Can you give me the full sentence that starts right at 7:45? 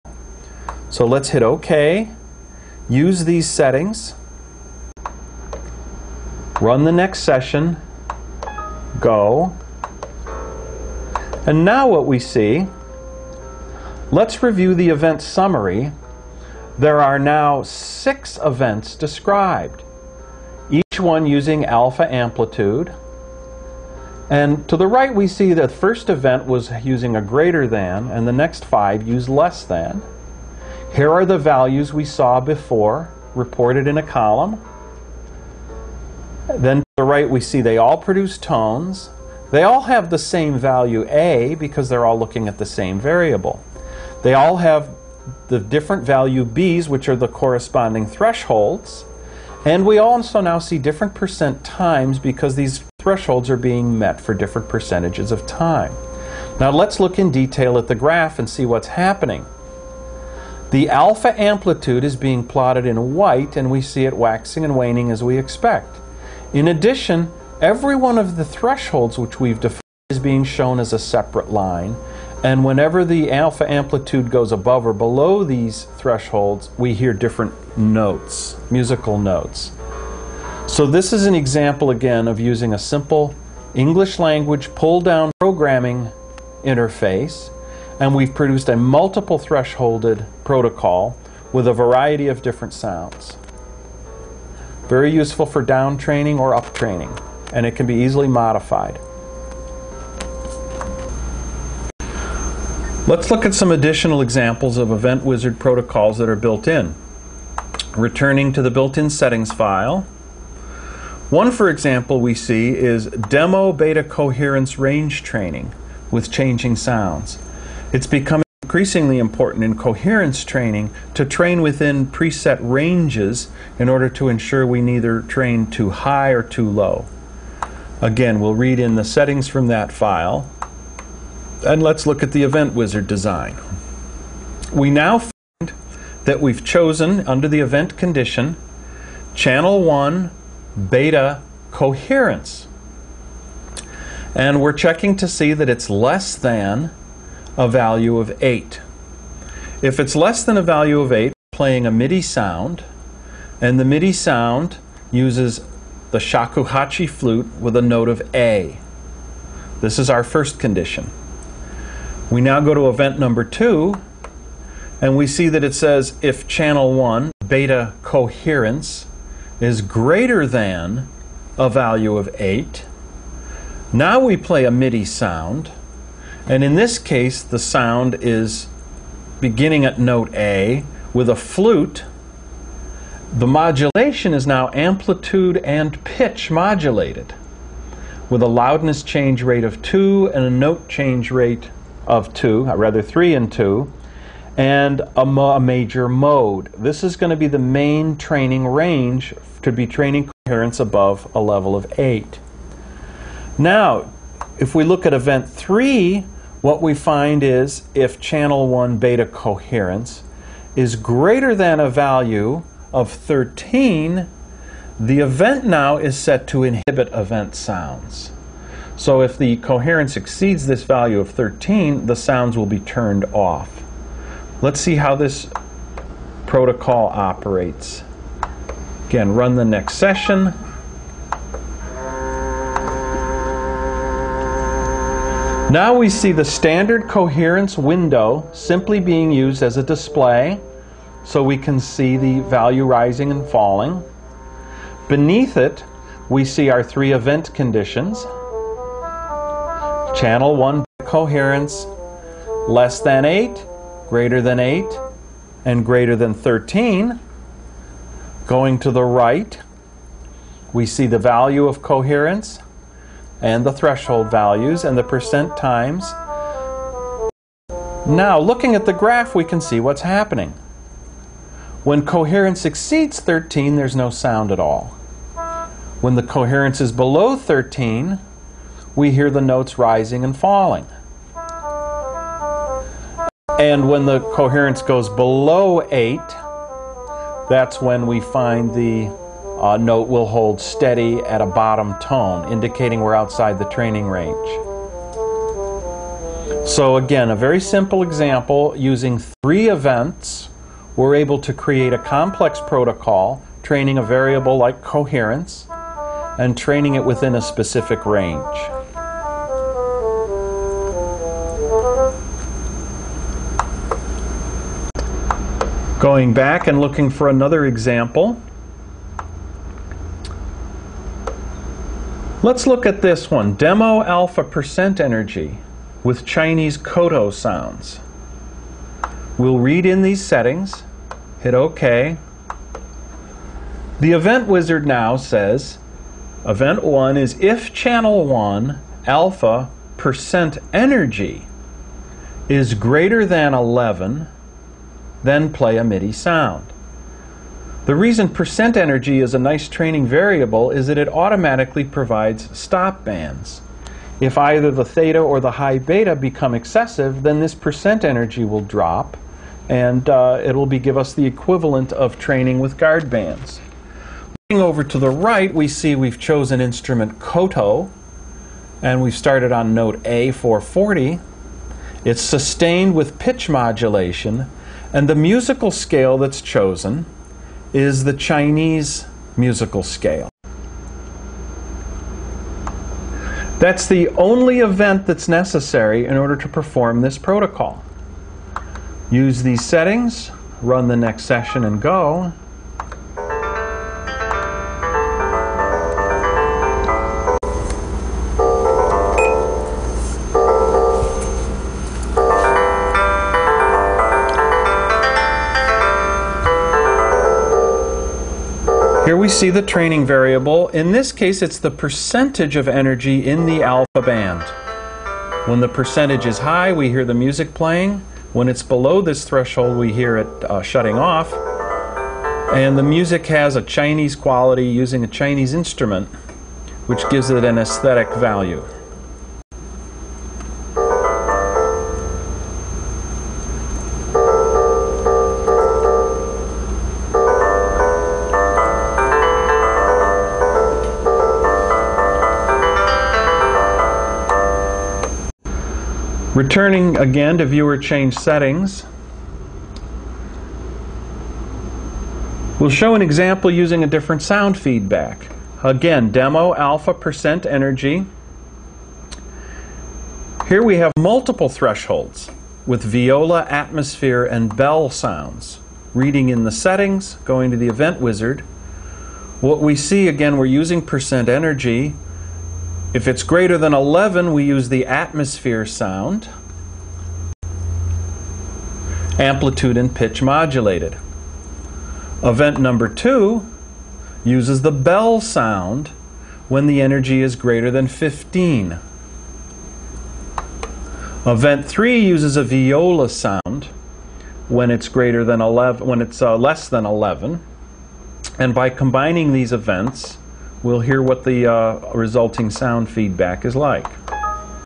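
Reading in the settings, going to the event wizard.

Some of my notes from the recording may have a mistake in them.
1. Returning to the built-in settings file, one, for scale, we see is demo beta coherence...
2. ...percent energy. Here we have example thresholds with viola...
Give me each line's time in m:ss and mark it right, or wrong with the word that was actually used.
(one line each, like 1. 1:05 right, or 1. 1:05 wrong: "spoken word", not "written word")
1. 1:47 wrong: "example", not "scale"
2. 7:36 wrong: "multiple", not "example".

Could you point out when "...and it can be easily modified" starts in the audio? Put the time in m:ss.
1:37.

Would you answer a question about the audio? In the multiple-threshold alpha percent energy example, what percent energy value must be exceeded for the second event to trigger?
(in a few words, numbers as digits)
15.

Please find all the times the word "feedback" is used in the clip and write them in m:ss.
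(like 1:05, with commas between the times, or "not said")
7:34, 8:22.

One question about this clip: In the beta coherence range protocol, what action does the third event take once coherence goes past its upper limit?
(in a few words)
Inhibit event sounds.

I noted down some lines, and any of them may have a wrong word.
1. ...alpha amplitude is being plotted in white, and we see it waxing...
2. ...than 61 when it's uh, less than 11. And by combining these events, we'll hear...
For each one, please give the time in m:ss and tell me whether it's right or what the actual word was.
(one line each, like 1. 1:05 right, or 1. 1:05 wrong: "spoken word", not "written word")
1. 1:00 right
2. 8:15 wrong: "11", not "61".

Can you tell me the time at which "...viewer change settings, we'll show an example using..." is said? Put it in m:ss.
7:27.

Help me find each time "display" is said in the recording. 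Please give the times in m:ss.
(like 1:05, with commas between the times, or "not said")
3:59.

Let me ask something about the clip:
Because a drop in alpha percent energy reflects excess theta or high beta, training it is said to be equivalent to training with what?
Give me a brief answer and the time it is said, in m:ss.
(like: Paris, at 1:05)
Guard bands, at 6:02.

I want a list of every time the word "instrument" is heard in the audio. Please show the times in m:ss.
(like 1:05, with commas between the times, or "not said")
6:06, 7:05.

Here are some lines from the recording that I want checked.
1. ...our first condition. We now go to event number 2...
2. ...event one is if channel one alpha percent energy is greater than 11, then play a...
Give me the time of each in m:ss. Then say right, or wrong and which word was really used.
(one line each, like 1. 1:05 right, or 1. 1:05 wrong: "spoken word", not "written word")
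1. 2:40 right
2. 5:36 right.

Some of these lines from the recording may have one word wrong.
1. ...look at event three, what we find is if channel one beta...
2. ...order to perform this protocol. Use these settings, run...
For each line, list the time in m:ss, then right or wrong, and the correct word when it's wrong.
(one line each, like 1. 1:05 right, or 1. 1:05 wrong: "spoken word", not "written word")
1. 3:24 right
2. 6:26 right.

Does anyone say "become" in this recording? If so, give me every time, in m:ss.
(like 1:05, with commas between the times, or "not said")
1:58, 5:56.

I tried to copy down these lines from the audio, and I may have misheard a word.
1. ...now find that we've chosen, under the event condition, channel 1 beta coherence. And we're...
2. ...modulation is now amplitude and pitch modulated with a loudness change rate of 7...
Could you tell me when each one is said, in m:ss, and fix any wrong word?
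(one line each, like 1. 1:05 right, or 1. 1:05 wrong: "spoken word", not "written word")
1. 2:14 right
2. 3:03 wrong: "2", not "7".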